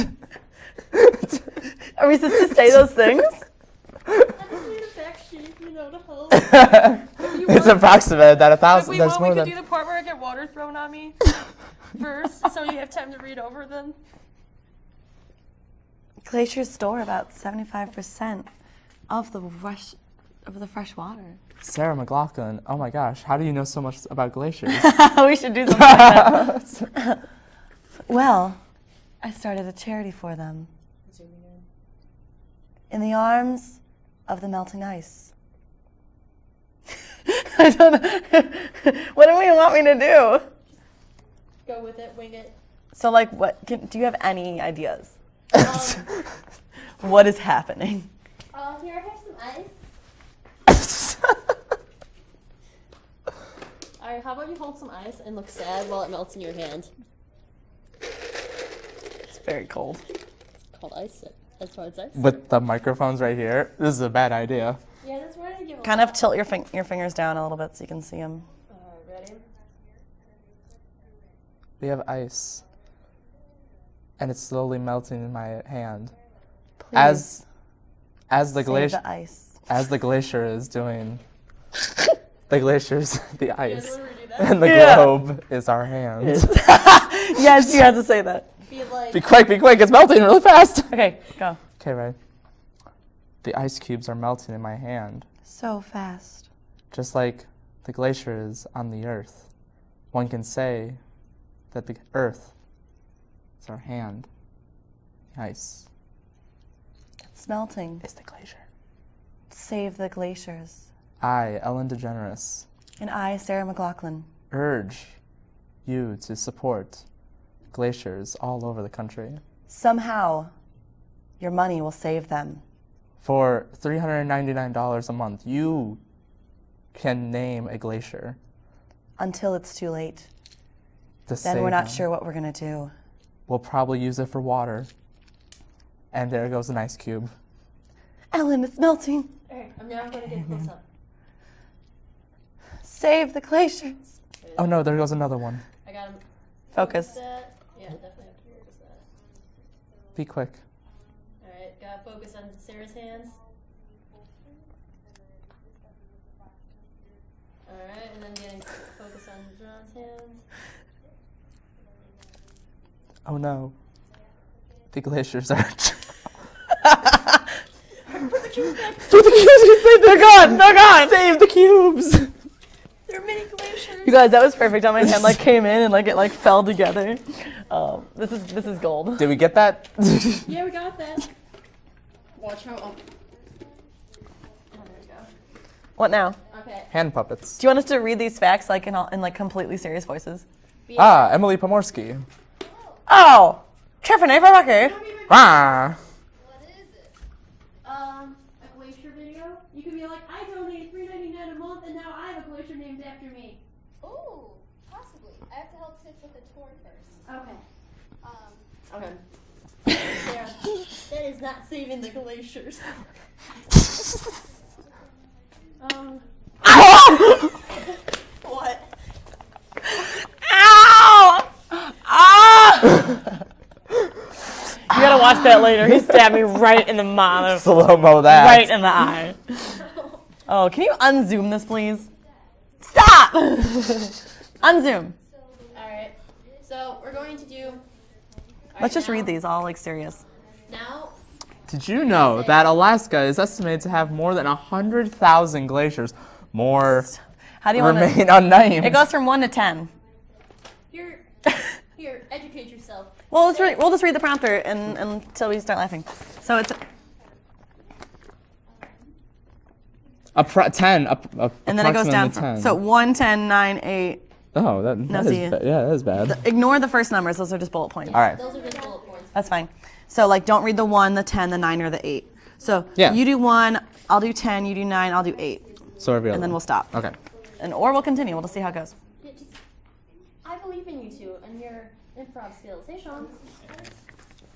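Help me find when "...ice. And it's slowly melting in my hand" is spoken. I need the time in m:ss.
1:12.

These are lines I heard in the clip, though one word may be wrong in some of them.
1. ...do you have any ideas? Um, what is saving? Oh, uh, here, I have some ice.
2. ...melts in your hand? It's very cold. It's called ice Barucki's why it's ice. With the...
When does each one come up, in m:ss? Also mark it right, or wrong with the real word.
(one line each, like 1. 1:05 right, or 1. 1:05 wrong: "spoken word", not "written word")
1. 0:43 wrong: "happening", not "saving"
2. 0:56 wrong: "That", not "Barucki".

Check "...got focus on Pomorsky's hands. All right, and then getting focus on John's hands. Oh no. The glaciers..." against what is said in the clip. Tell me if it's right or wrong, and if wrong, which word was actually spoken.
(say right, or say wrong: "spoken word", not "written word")
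wrong: "Sarah", not "Pomorsky".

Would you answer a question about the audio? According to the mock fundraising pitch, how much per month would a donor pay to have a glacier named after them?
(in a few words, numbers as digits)
$399.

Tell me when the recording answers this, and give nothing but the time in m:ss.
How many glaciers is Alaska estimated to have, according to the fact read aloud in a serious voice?
4:04.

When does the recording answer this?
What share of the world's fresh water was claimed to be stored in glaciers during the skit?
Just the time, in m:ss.
0:17.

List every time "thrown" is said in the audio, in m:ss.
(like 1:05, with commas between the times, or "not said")
0:10.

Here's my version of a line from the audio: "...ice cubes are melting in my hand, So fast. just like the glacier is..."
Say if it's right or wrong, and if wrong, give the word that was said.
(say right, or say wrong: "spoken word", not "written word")
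right.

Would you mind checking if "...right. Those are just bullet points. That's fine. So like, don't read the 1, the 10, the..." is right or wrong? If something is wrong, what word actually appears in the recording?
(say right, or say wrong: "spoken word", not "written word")
right.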